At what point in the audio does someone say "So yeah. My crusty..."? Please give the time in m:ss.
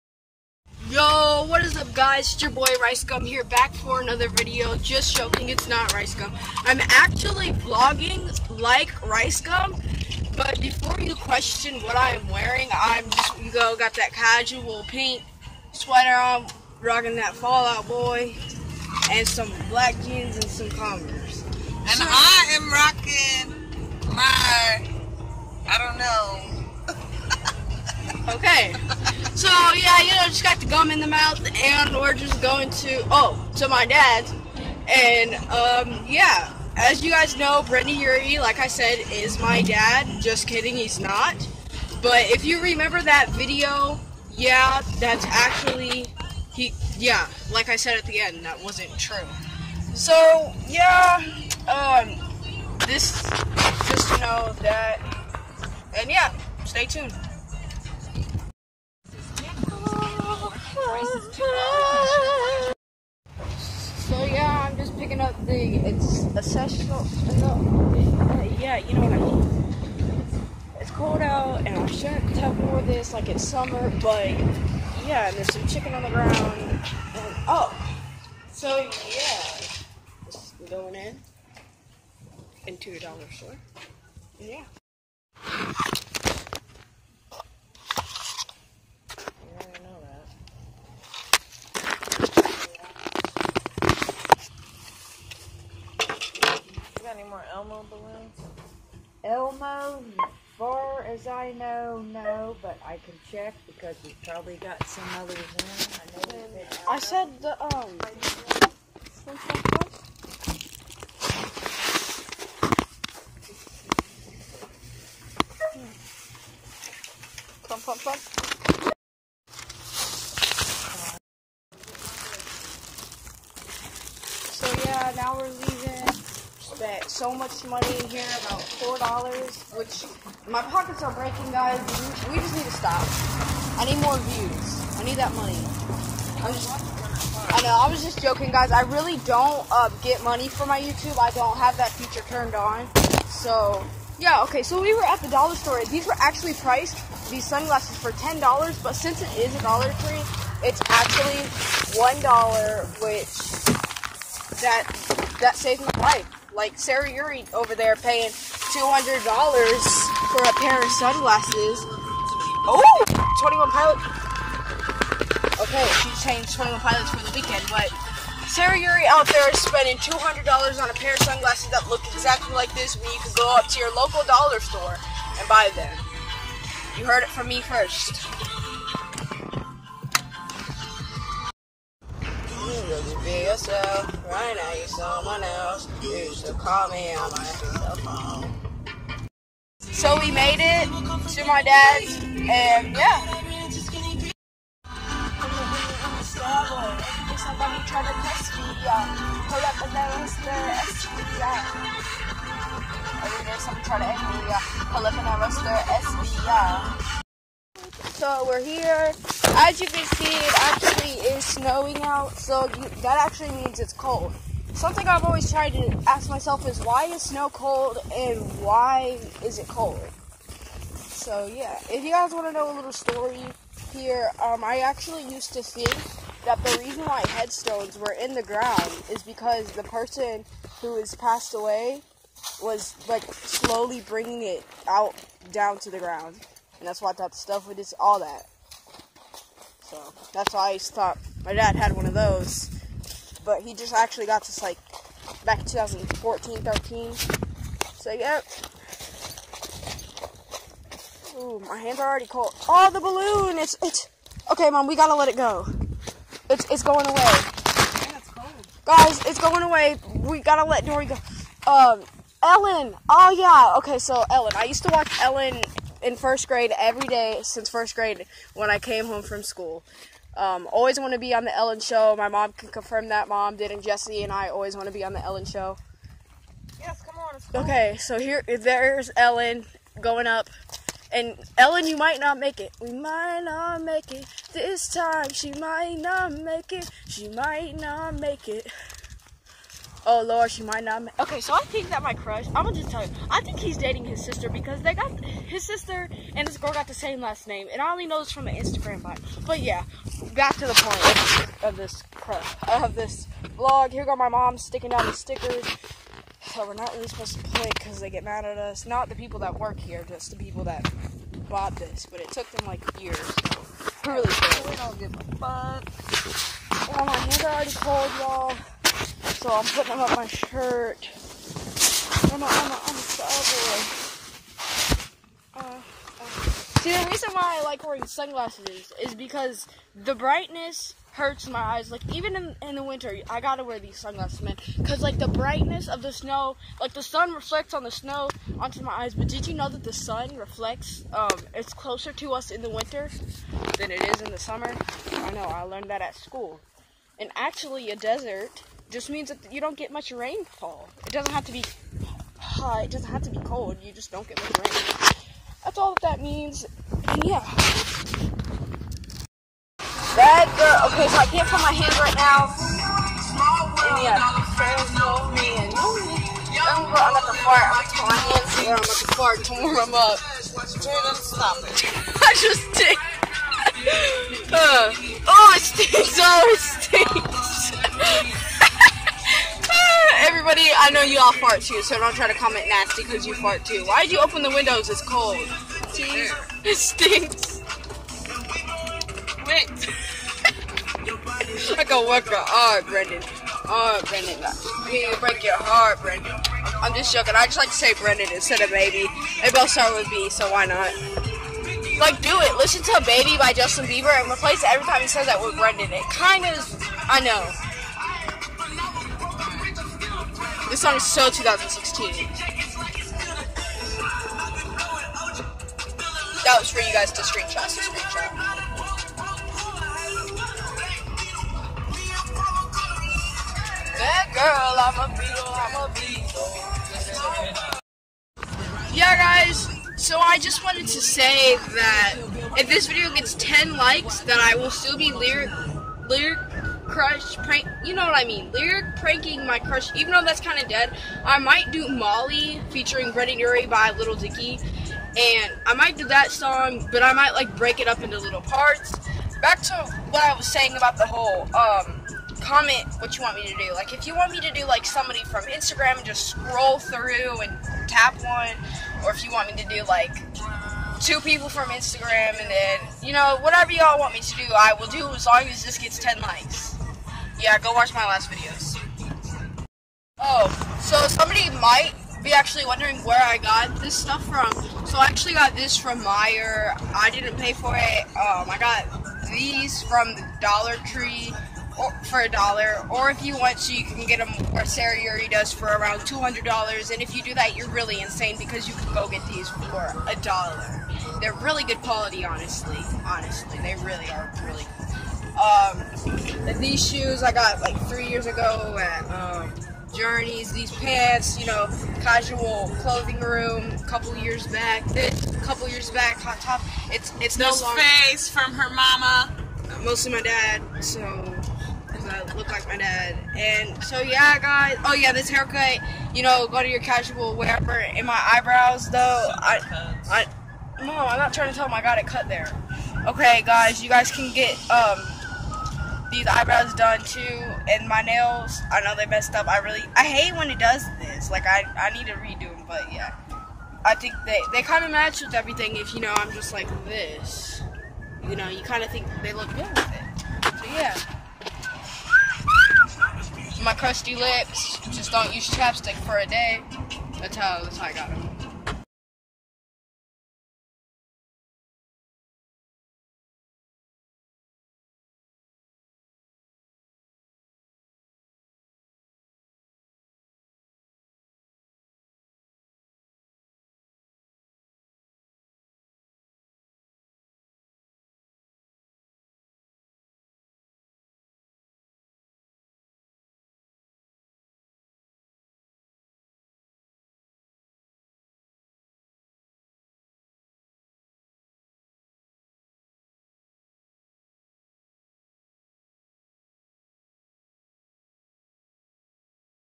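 9:00.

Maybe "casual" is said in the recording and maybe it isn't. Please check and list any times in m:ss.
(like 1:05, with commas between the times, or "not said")
0:14, 8:22, 8:36.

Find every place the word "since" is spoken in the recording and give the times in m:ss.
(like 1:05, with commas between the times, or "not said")
2:28, 4:27.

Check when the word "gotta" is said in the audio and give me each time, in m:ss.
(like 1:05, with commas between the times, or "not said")
4:14, 4:20, 5:33.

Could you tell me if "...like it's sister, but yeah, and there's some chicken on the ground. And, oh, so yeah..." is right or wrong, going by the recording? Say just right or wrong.
wrong.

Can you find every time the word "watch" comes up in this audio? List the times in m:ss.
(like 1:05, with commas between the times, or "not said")
4:24, 7:47.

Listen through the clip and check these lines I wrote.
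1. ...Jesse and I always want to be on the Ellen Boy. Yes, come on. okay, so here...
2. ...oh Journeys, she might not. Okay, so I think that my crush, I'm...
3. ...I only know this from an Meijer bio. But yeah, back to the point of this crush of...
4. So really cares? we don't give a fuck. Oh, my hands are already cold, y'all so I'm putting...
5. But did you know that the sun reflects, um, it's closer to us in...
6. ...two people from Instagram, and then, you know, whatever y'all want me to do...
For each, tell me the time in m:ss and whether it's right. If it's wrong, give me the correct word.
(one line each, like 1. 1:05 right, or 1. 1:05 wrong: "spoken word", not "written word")
1. 4:33 wrong: "Show", not "Boy"
2. 4:50 wrong: "Lord", not "Journeys"
3. 4:57 wrong: "Instagram", not "Meijer"
4. 5:13 right
5. 5:39 right
6. 7:41 right.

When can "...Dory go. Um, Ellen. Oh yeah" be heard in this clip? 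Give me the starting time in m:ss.
4:20.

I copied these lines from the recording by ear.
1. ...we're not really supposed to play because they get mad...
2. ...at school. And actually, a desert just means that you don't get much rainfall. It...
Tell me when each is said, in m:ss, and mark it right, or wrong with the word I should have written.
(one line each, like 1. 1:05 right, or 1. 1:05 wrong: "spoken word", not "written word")
1. 5:06 right
2. 5:46 right.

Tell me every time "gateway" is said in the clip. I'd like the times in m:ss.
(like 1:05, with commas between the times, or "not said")
not said.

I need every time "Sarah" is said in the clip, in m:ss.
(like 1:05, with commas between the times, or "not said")
2:36, 2:48, 8:04.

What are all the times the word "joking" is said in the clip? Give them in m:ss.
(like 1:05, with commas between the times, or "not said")
0:05, 2:18, 6:37.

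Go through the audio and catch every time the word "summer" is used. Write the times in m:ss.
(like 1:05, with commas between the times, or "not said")
1:13, 5:44.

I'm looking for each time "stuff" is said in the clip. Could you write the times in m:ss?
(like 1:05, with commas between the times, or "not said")
3:57, 7:53.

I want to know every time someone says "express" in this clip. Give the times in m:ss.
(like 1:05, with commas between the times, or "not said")
not said.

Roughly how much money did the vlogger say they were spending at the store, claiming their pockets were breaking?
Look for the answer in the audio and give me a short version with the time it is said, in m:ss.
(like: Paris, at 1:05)
about 4 dollars, at 2:08.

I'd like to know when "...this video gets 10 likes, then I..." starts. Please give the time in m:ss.
7:12.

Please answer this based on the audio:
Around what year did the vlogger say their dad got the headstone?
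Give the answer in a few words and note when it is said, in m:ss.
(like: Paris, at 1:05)
2014, at 4:05.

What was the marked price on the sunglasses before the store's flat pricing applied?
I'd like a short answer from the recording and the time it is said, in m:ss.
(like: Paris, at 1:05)
10 dollars, at 2:28.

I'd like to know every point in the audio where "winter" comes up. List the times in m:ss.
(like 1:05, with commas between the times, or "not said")
5:32, 5:42.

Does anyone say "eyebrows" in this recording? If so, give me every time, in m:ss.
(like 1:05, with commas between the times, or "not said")
8:38, 8:46.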